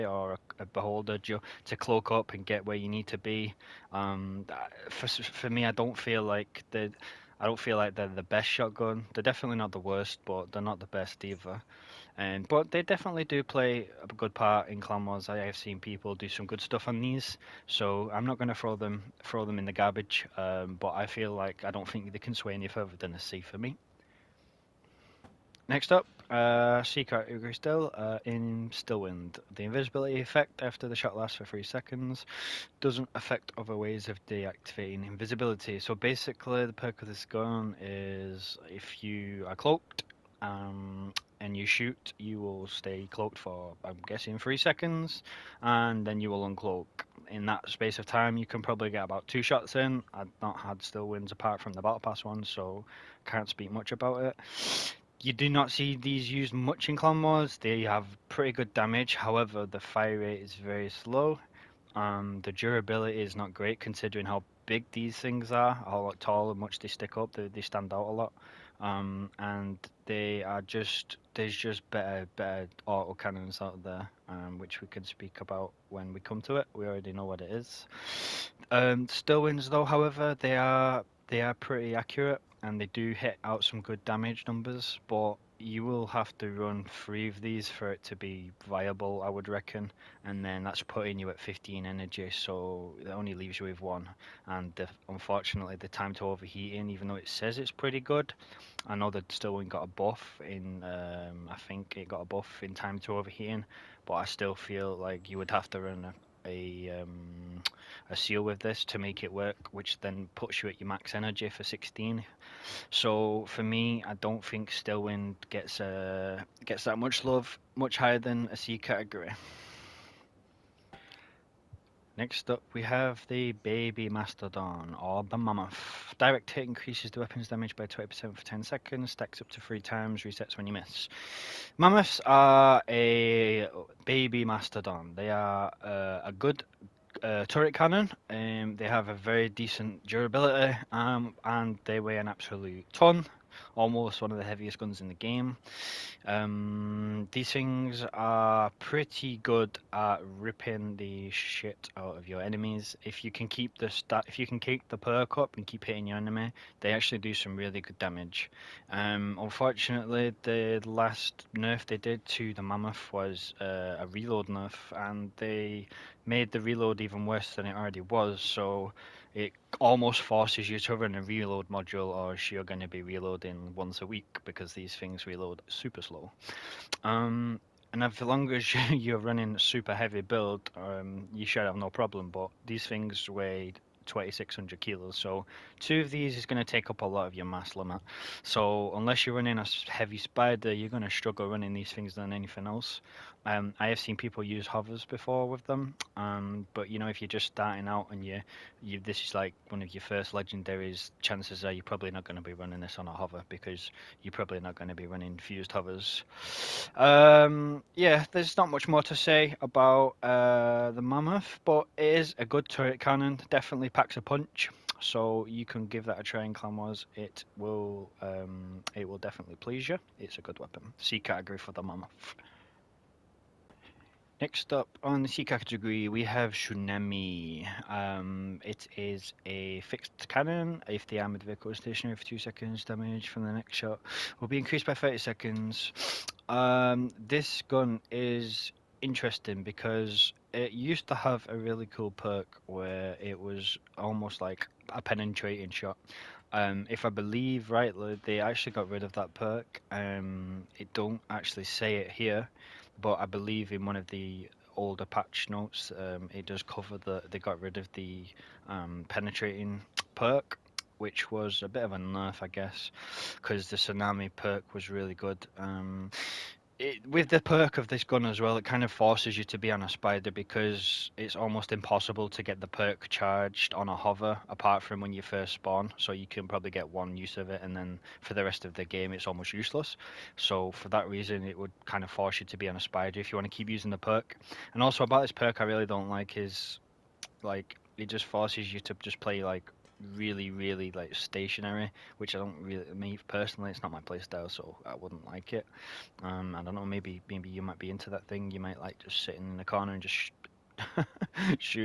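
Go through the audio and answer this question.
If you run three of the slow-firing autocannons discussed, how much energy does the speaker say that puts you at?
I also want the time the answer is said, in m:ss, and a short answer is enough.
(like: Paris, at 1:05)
15, at 1:31.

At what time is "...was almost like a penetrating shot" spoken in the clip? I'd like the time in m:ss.
4:03.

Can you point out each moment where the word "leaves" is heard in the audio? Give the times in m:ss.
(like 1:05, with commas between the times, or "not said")
1:33.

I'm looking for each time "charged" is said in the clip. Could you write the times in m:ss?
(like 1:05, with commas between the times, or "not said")
4:33.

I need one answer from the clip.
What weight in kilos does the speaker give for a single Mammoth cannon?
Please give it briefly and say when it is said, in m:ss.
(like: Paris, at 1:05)
2600, at 3:04.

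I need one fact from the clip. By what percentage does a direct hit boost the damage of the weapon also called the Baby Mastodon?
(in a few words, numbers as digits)
20%.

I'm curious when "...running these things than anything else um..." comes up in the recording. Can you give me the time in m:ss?
3:11.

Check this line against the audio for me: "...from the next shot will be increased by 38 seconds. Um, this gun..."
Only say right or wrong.
wrong.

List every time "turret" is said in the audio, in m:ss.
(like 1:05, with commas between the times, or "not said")
2:17, 3:32.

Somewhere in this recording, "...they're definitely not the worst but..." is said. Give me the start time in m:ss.
0:09.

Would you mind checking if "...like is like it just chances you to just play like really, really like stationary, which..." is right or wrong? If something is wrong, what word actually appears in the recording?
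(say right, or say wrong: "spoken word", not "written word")
wrong: "forces", not "chances".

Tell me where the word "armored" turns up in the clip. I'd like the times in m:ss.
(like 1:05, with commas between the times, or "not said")
3:51.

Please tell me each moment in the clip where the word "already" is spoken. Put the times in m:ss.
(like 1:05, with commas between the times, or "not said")
1:16, 2:47.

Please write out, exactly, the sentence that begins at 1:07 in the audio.
They, they stand out a lot.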